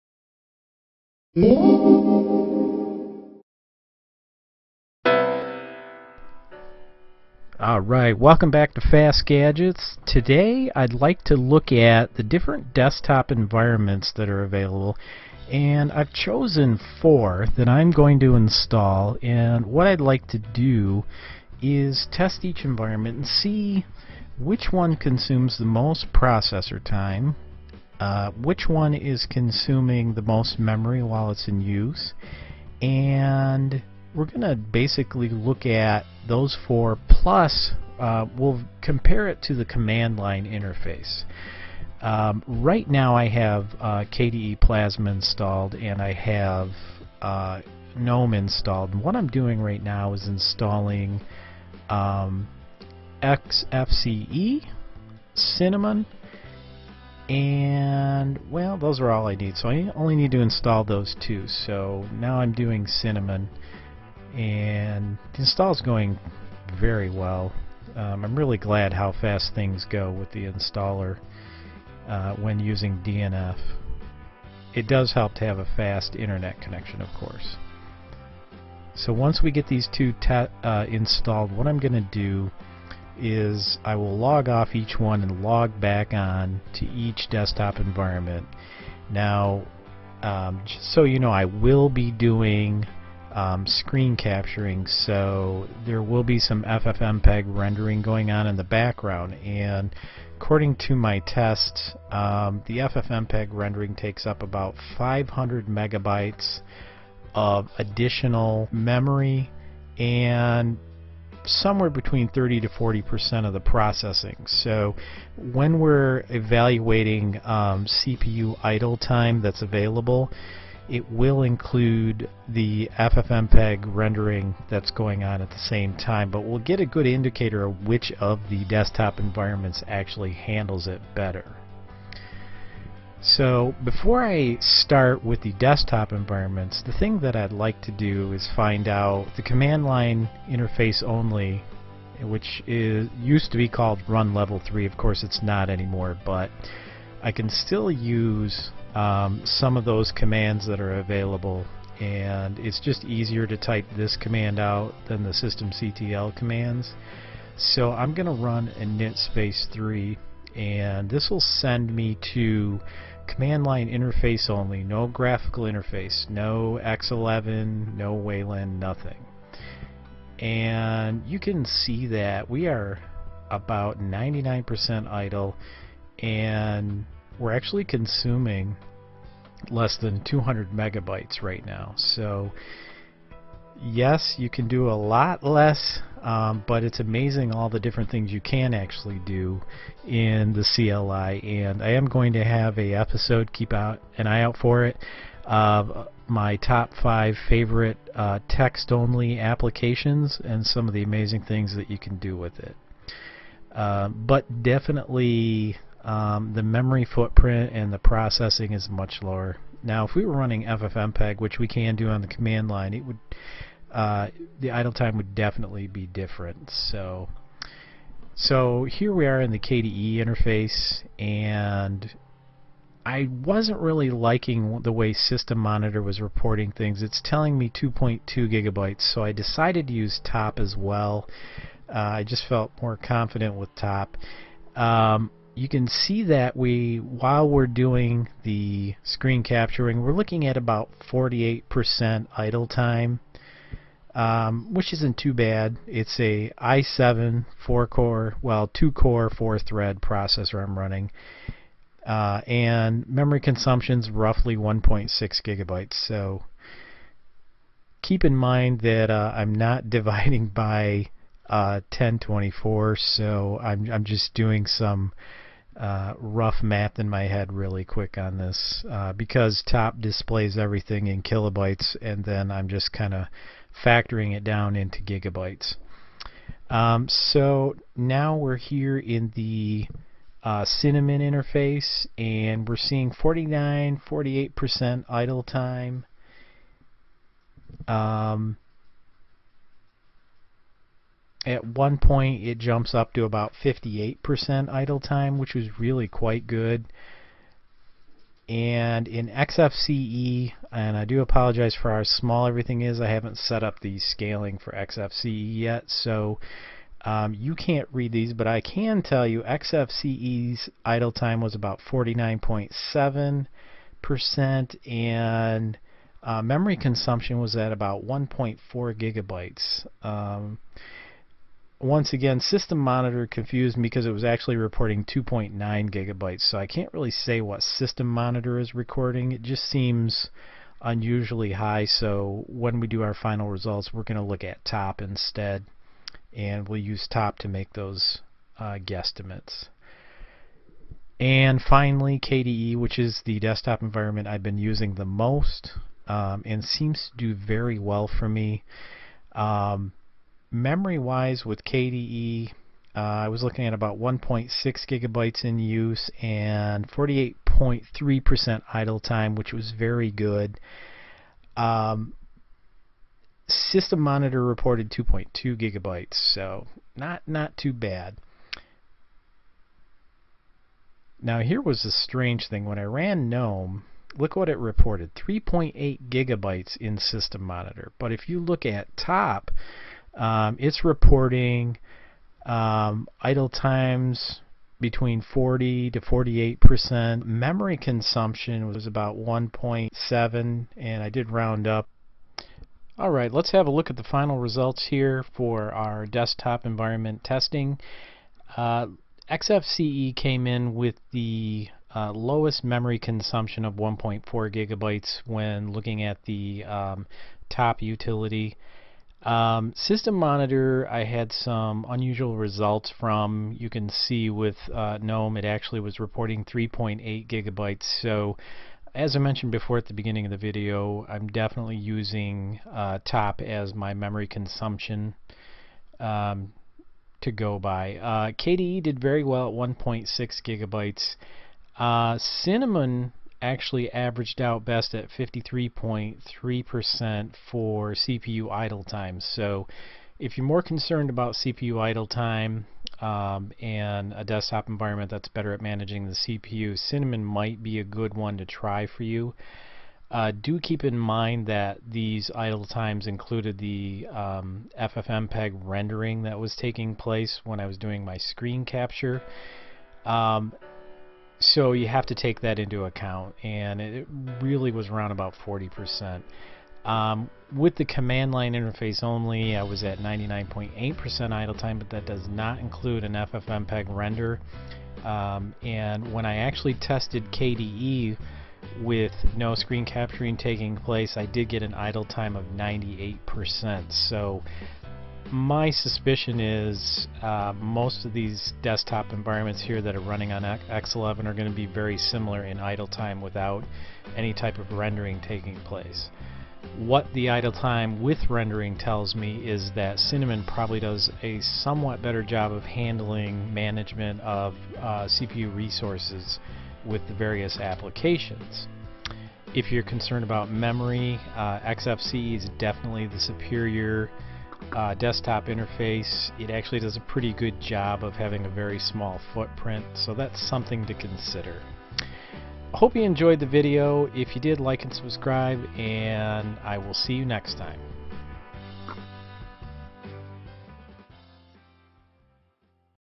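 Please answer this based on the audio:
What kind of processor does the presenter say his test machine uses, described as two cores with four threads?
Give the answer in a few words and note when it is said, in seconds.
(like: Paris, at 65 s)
i7, at 246 s.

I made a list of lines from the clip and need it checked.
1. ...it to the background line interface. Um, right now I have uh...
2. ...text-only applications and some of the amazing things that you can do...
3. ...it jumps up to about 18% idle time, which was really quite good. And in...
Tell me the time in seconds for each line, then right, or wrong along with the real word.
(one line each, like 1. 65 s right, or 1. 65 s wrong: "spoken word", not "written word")
1. 39 s wrong: "command", not "background"
2. 198 s right
3. 292 s wrong: "58", not "18".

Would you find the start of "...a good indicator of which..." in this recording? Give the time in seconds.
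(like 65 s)
126 s.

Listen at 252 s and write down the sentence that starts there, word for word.
Uh, and memory consumption's roughly 1.6 gigabytes.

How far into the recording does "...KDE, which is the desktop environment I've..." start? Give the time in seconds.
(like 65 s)
342 s.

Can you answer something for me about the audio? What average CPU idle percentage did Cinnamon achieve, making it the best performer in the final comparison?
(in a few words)
53.3%.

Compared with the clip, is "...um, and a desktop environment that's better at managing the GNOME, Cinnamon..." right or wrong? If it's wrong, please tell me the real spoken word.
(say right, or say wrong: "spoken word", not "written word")
wrong: "CPU", not "GNOME".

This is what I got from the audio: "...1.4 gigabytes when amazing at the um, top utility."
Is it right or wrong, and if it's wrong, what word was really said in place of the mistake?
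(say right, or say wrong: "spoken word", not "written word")
wrong: "looking", not "amazing".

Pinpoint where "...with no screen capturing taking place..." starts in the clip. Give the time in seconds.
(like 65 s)
478 s.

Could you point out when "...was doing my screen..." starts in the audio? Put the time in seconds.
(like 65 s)
457 s.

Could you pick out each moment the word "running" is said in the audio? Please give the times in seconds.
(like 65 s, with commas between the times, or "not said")
210 s, 250 s, 490 s.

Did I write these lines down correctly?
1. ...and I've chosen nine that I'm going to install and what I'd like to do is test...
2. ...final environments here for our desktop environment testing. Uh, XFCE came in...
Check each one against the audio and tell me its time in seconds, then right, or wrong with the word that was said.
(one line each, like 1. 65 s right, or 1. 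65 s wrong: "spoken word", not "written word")
1. 15 s wrong: "four", not "nine"
2. 394 s wrong: "results", not "environments".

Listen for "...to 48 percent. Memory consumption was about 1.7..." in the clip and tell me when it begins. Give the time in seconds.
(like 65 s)
385 s.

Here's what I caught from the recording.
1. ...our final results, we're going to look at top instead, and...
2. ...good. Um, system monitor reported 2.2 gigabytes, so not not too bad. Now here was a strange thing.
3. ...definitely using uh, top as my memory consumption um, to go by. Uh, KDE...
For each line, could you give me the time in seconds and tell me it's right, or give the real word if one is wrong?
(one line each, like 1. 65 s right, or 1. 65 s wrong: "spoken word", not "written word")
1. 333 s right
2. 360 s right
3. 421 s right.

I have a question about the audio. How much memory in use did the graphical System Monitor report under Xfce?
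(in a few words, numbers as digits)
2.9 gigabytes.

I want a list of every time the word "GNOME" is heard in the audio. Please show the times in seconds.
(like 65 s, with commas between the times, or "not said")
47 s, 373 s, 415 s.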